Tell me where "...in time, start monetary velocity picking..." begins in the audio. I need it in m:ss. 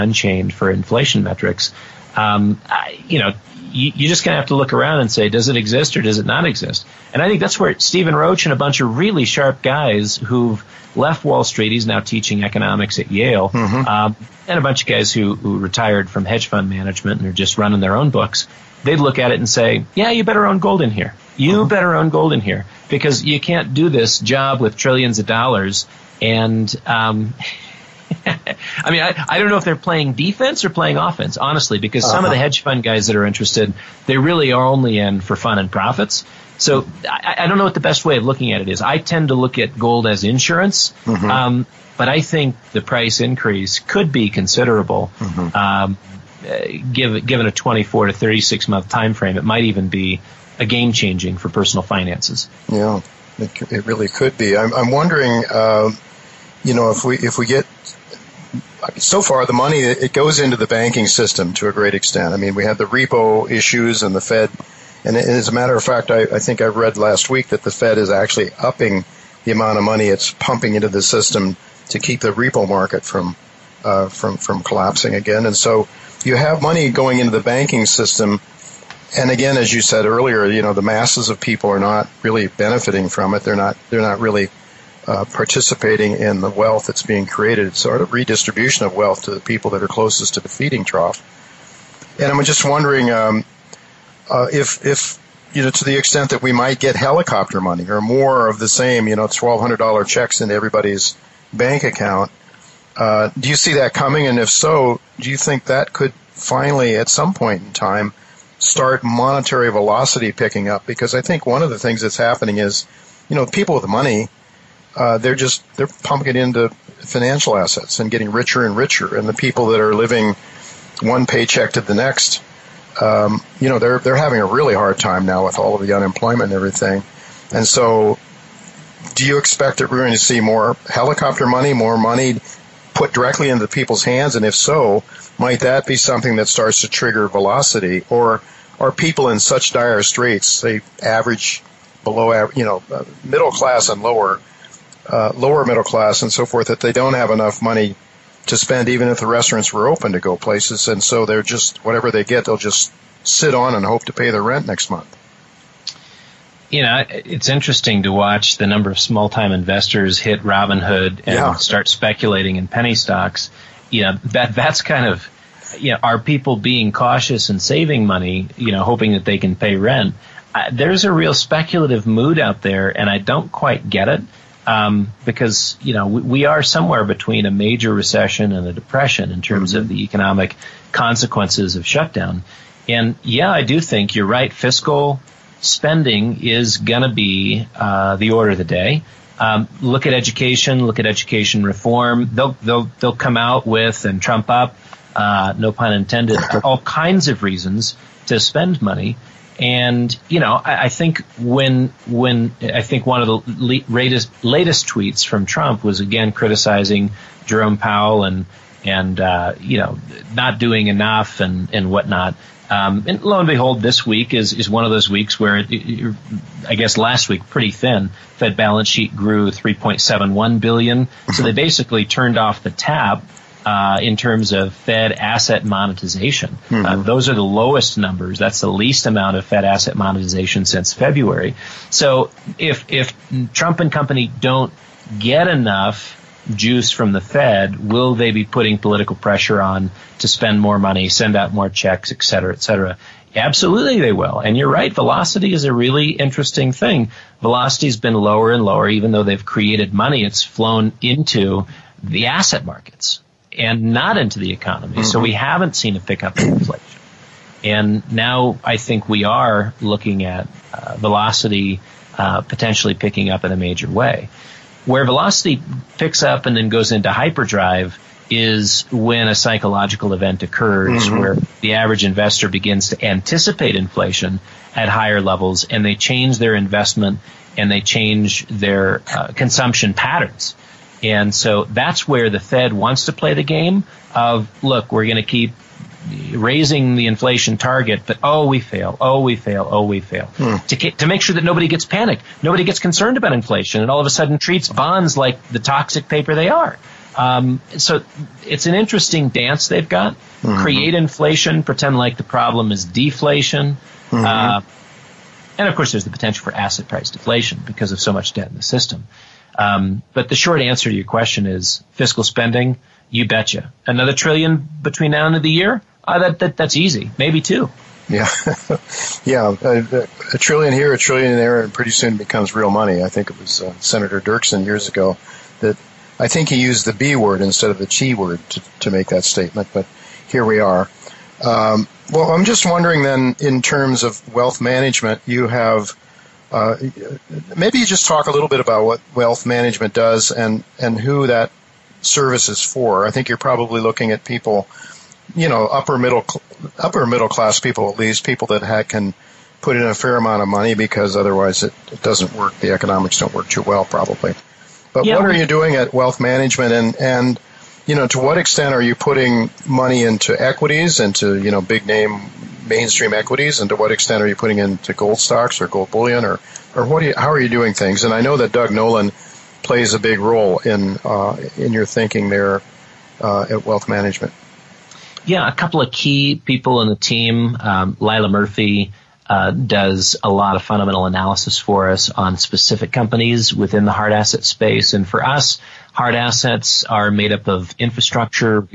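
1:47.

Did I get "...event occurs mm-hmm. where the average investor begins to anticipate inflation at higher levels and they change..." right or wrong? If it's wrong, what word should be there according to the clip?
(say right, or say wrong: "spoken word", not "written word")
right.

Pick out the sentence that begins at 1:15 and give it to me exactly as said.
And so you have money going into the banking system.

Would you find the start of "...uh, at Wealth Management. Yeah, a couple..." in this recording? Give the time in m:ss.
6:13.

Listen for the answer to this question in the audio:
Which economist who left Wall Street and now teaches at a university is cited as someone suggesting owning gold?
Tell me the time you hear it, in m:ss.
0:07.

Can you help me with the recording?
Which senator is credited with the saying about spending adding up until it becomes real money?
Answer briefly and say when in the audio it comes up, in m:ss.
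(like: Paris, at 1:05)
Senator Dirksen, at 5:23.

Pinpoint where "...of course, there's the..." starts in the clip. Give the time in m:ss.
5:05.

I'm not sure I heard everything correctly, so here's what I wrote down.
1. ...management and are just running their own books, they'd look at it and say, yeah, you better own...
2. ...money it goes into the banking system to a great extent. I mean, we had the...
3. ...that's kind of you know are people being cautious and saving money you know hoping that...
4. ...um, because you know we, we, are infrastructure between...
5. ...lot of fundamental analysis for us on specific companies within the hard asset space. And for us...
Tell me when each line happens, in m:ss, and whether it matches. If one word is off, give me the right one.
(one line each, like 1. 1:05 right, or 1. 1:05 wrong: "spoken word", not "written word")
1. 0:16 right
2. 0:59 right
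3. 2:44 right
4. 2:54 wrong: "somewhere", not "infrastructure"
5. 6:20 right.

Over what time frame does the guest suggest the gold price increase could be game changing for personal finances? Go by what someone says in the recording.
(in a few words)
24 to 36 months.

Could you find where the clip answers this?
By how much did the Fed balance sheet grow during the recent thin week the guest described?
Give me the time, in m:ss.
3:39.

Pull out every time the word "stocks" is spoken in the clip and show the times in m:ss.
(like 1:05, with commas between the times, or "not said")
2:42, 6:05.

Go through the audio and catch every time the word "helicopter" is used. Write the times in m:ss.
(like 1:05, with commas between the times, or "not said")
1:36, 2:10.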